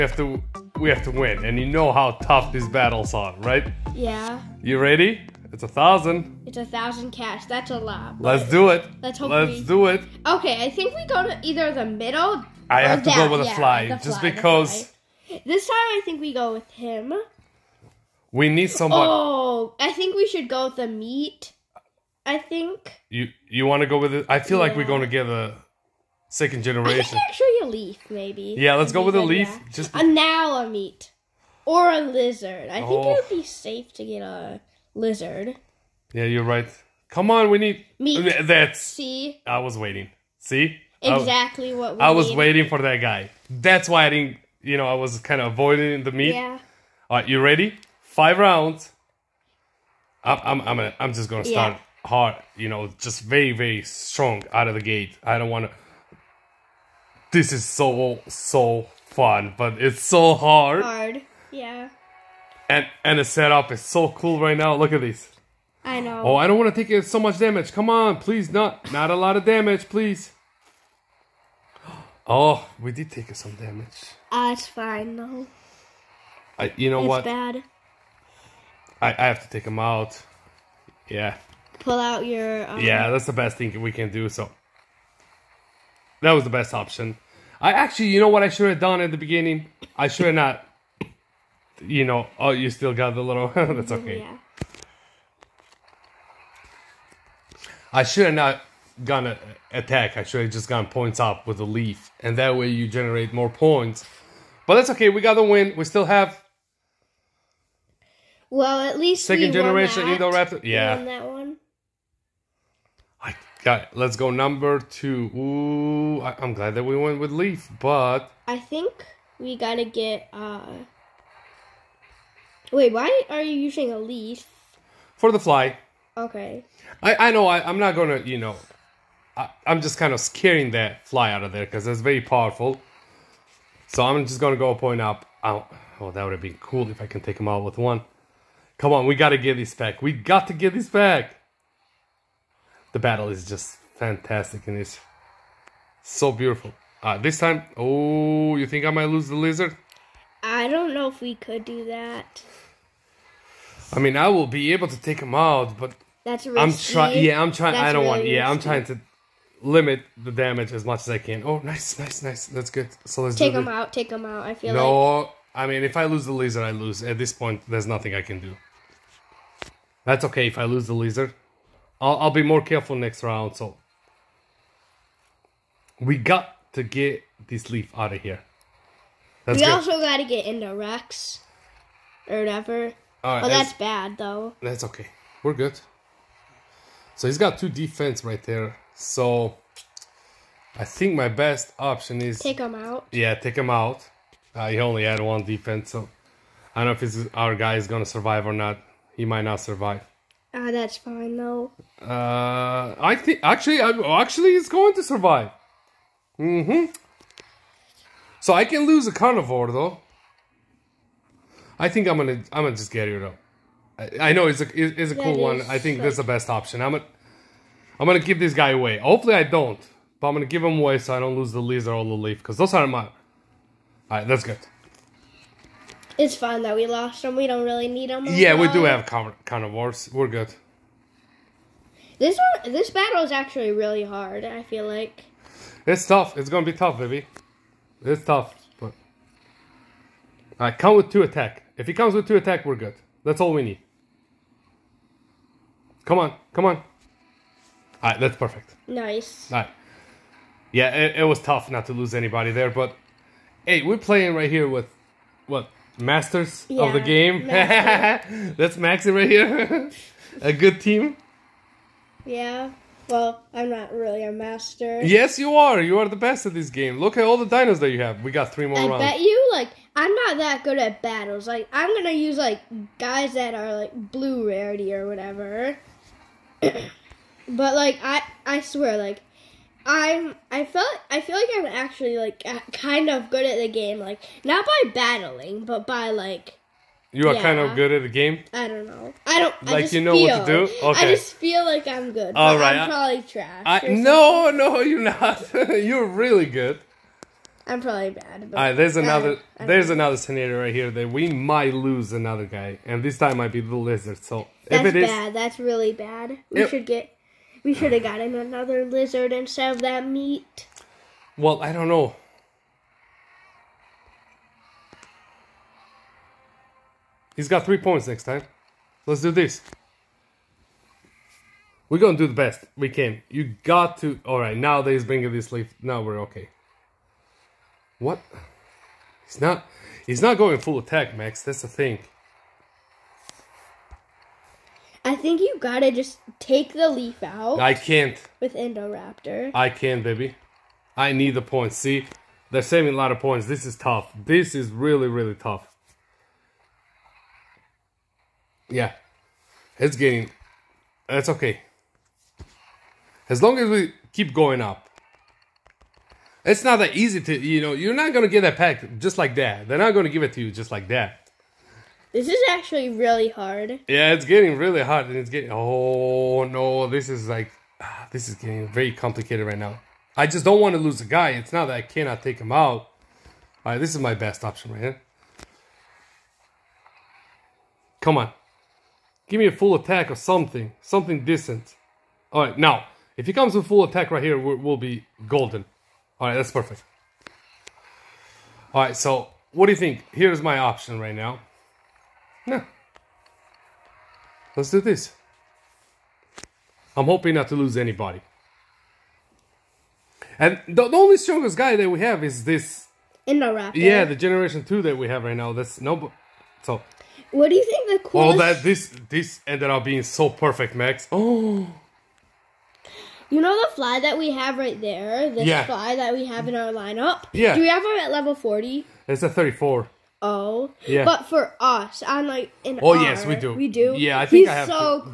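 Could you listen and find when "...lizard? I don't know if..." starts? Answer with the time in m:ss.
2:29.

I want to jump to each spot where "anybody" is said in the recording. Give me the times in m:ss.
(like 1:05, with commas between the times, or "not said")
4:12, 6:37.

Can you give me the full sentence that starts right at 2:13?
So I'm just gonna go point up.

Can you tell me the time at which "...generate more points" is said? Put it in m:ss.
1:42.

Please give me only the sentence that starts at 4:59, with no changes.
another scenario right here that we might lose another guy, and this time might be the lizard.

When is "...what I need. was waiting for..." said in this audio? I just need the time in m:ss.
0:41.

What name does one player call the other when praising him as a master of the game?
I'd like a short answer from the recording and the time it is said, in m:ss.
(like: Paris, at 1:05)
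Maxi, at 4:18.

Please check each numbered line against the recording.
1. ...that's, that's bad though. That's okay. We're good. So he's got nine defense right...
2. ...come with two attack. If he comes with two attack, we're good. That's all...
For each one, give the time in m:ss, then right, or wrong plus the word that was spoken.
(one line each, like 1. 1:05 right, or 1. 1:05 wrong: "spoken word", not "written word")
1. 3:03 wrong: "two", not "nine"
2. 4:00 right.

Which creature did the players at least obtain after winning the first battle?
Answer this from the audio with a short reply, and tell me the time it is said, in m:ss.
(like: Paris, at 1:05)
second generation Indoraptor, at 1:49.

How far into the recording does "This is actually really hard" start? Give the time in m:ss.
6:02.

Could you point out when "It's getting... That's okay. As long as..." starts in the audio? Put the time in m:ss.
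5:49.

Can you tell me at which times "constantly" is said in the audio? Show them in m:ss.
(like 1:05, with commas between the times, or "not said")
not said.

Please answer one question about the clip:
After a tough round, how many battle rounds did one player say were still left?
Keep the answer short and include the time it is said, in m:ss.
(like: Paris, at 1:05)
3, at 4:28.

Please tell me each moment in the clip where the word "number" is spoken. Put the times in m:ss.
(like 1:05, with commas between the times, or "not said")
1:54.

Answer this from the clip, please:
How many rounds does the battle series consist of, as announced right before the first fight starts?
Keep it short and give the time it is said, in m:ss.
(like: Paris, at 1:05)
5, at 0:48.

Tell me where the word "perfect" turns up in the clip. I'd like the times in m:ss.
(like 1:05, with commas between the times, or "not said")
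4:08, 6:26, 6:50.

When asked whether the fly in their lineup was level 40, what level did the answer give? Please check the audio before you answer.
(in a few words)
34.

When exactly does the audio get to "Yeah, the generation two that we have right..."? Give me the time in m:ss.
6:43.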